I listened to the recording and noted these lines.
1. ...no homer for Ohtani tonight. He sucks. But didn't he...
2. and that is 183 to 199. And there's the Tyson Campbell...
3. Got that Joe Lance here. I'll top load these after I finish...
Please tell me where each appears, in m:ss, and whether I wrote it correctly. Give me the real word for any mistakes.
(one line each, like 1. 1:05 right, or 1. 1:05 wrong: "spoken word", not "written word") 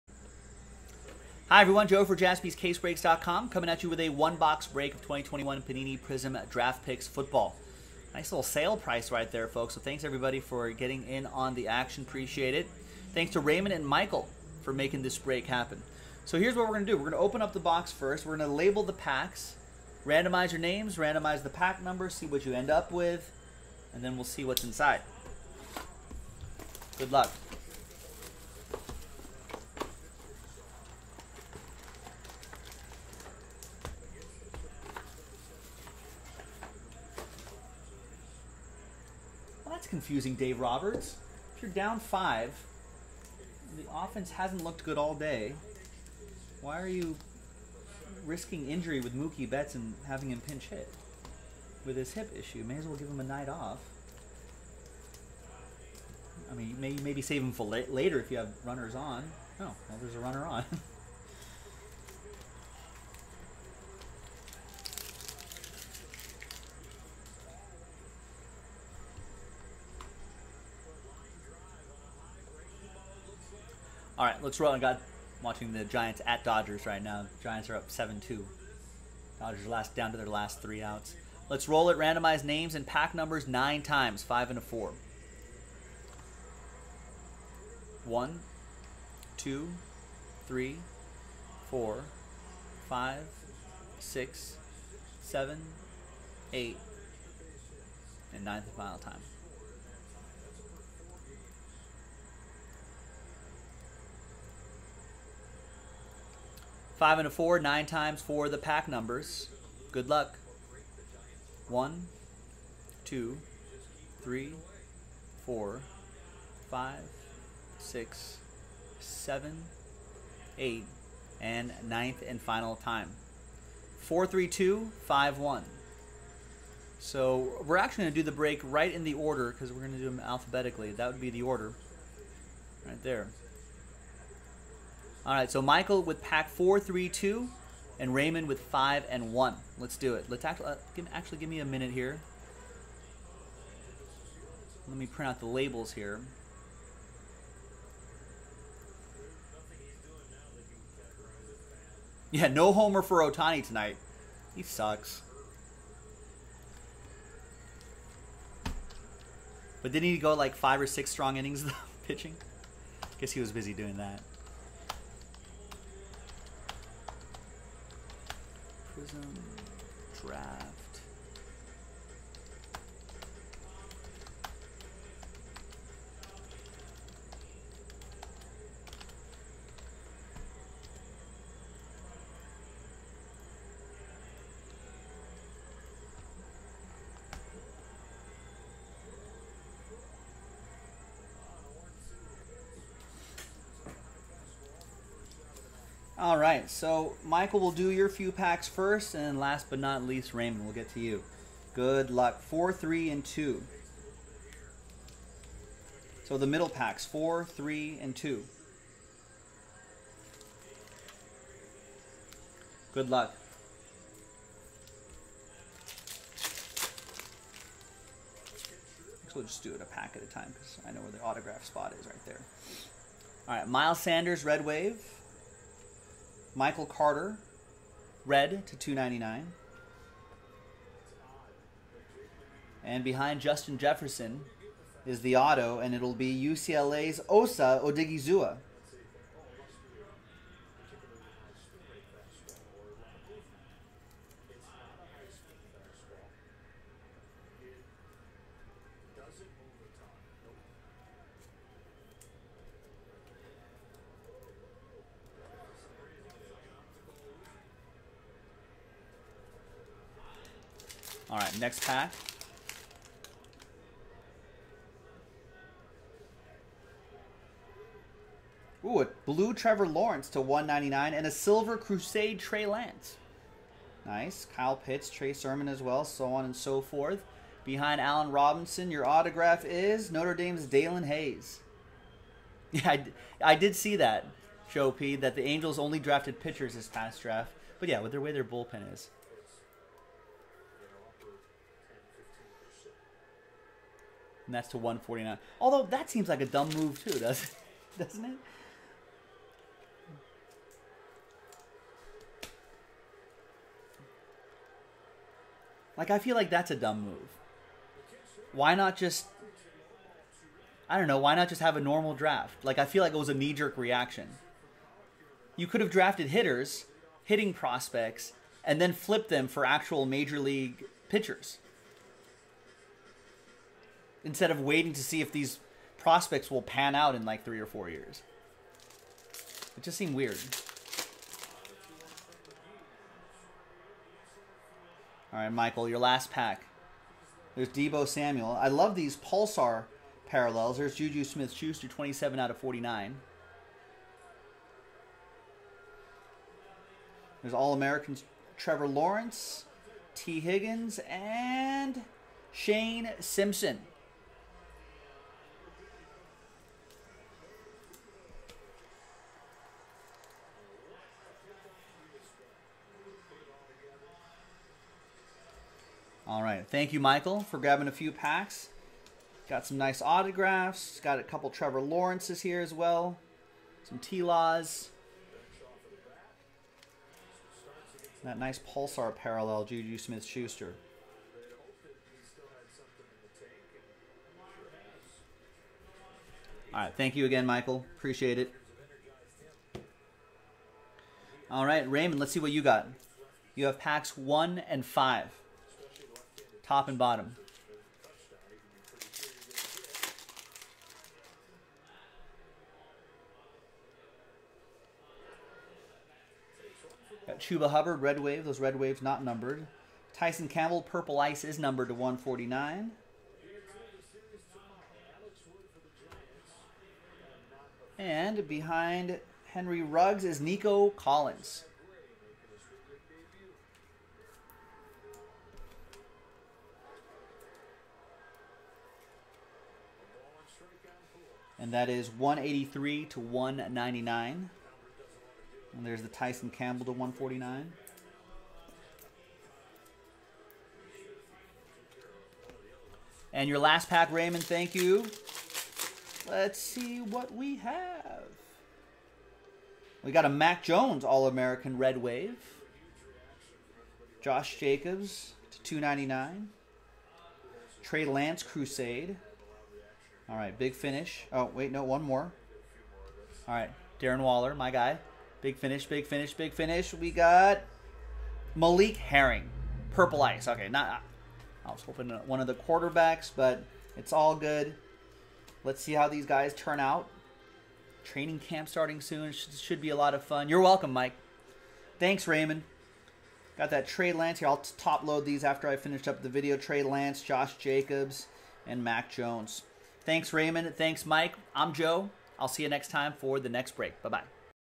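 1. 2:32 right
2. 7:11 right
3. 8:03 wrong: "Trey", not "Joe".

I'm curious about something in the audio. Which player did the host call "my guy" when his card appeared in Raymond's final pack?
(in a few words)
Darren Waller.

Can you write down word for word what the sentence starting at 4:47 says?
But yeah, with their way their bullpen is.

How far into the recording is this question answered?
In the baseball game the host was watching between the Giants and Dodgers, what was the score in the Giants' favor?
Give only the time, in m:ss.
1:17.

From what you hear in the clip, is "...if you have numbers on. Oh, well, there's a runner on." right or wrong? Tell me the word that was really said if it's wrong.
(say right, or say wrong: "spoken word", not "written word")
wrong: "runners", not "numbers".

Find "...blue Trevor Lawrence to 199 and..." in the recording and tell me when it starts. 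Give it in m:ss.
4:29.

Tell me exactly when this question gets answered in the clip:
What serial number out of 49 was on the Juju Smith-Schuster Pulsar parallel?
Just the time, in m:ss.
5:41.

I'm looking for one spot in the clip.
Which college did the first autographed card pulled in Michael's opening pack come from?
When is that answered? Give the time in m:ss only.
3:56.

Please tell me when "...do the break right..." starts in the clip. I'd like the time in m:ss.
2:08.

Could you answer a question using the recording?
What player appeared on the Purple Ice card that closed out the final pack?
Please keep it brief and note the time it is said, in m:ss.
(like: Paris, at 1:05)
Malik Herring, at 7:48.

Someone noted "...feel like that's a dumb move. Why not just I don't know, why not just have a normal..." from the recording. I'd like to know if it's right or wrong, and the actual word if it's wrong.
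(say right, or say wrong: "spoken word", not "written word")
right.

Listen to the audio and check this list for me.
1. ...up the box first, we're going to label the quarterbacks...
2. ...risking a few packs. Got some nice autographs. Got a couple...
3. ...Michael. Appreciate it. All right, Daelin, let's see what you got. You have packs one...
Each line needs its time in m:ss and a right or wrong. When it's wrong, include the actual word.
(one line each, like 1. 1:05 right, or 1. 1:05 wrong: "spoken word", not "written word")
1. 0:17 wrong: "packs", not "quarterbacks"
2. 6:07 wrong: "grabbing", not "risking"
3. 6:27 wrong: "Raymond", not "Daelin".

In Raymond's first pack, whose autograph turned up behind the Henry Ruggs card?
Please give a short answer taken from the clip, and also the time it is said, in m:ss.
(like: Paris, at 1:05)
Nico Collins, at 7:00.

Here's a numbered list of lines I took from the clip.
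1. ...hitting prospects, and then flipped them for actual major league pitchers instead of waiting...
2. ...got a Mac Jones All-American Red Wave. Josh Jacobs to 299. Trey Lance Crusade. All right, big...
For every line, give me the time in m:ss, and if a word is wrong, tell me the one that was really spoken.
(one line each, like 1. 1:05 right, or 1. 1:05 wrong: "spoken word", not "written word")
1. 5:17 right
2. 7:30 right.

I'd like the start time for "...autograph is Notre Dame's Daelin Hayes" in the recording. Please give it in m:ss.
4:39.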